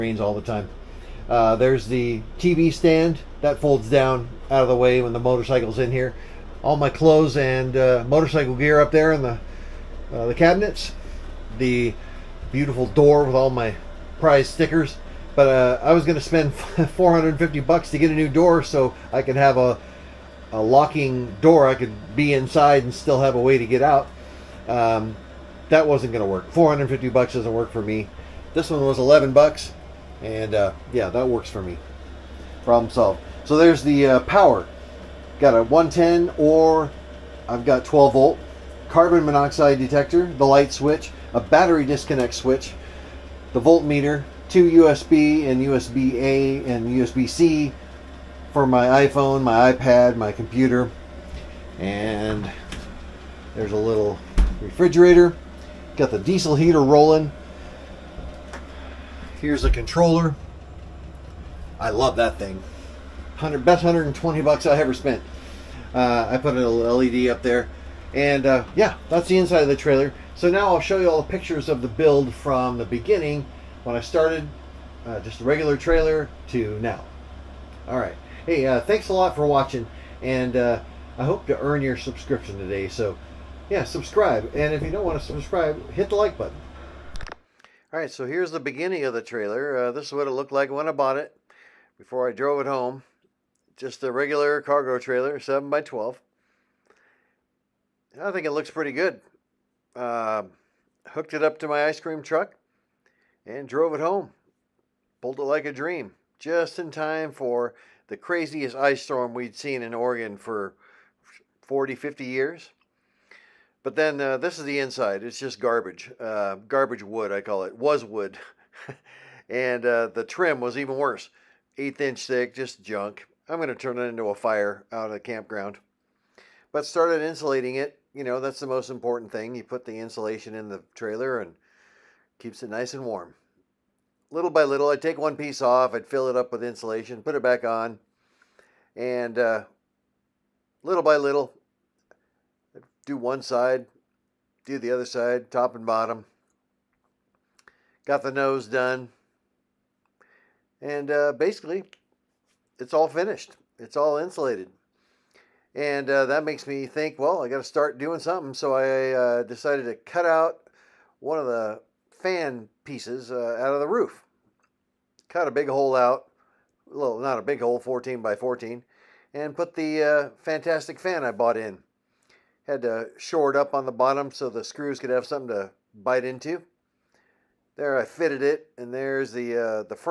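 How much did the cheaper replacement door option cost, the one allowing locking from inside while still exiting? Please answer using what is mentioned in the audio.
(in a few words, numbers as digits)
$11.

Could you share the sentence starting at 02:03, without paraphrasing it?
I'm going to turn it into a fire out at the campground.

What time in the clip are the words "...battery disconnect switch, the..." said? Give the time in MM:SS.
00:41.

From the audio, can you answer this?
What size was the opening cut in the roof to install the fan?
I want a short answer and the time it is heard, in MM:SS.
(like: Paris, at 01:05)
14 by 14, at 02:47.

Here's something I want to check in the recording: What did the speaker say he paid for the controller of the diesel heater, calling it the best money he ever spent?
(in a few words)
$120.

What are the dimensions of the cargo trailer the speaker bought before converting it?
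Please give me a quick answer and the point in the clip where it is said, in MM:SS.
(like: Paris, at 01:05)
7 by 12, at 01:35.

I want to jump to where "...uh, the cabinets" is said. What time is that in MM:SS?
00:10.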